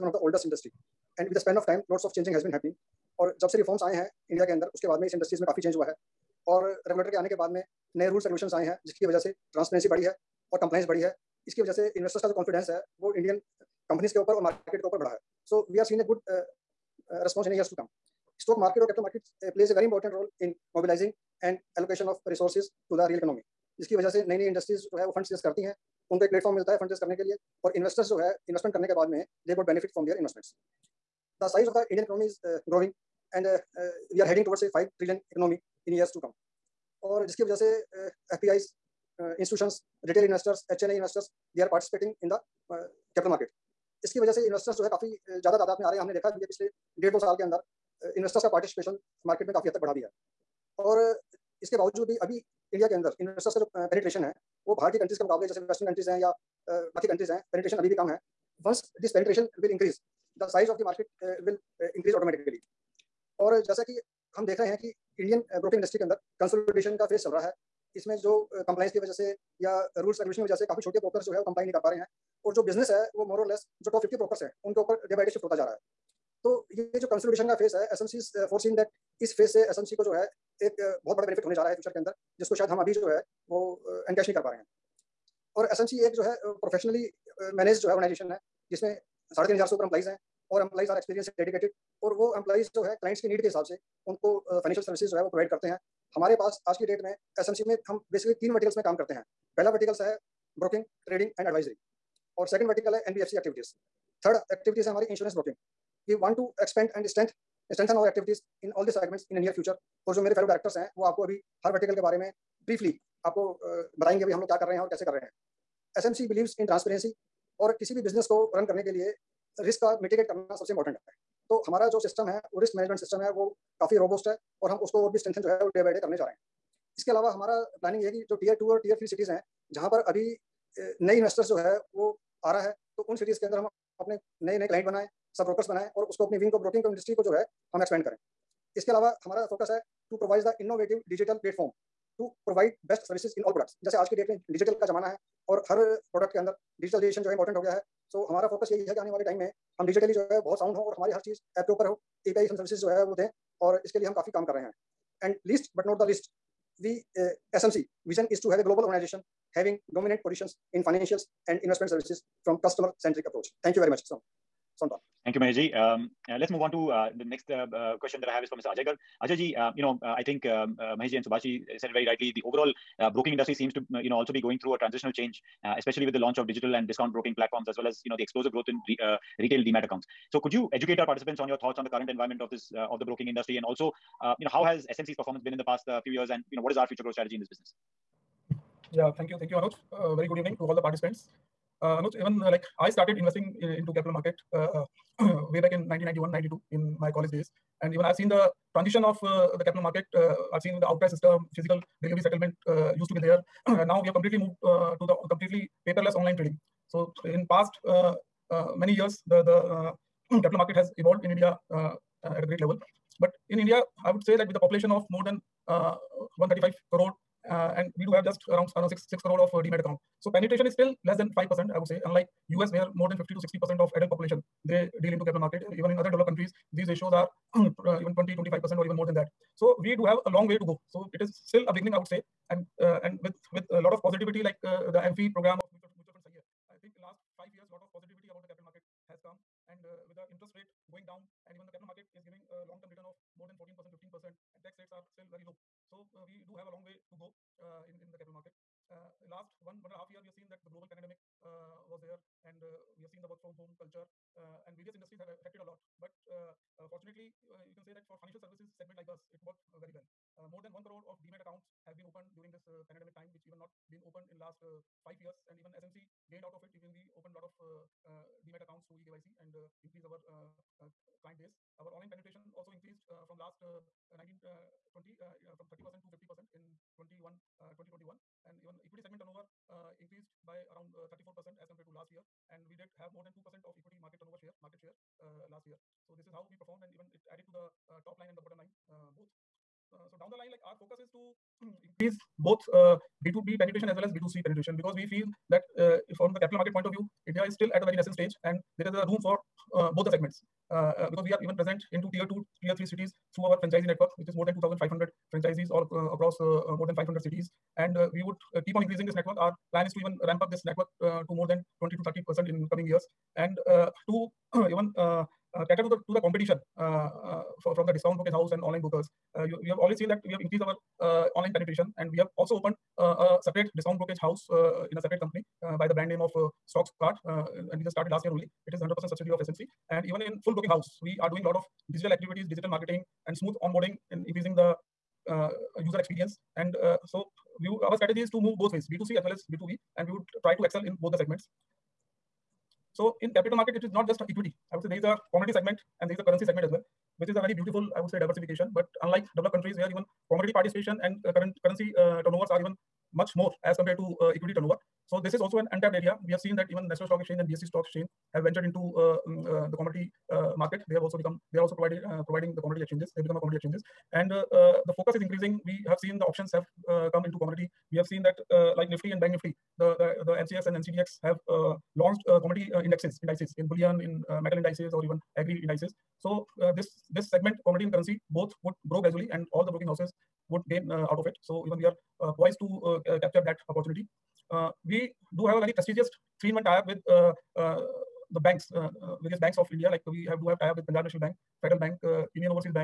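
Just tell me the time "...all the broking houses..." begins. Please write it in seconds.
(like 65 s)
379 s.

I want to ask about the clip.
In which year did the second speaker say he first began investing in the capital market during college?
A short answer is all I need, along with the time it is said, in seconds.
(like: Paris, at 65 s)
1991, at 195 s.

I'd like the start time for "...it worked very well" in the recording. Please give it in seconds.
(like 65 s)
259 s.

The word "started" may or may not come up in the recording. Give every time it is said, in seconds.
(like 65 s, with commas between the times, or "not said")
192 s, 327 s.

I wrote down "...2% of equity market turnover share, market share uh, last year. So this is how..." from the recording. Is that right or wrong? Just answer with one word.
right.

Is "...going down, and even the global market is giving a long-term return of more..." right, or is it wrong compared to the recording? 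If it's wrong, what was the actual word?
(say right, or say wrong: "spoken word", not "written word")
wrong: "capital", not "global".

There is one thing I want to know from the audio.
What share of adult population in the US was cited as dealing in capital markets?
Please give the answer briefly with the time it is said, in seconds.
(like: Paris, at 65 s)
50 to 60 percent, at 223 s.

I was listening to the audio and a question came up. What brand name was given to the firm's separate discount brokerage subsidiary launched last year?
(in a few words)
Stocks Cart.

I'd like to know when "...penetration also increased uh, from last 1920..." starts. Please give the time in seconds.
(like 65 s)
272 s.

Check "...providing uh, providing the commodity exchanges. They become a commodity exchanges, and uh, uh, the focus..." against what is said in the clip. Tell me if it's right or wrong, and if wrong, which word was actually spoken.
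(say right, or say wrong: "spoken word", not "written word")
right.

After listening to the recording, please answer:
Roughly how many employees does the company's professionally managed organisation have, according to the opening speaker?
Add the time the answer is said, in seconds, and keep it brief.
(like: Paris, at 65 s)
3,500, at 89 s.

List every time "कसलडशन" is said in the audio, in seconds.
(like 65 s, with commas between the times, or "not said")
66 s, 77 s.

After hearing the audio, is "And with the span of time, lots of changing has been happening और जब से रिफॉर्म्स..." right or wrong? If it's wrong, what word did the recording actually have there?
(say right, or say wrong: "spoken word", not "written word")
right.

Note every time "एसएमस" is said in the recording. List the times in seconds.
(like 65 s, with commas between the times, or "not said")
85 s, 97 s.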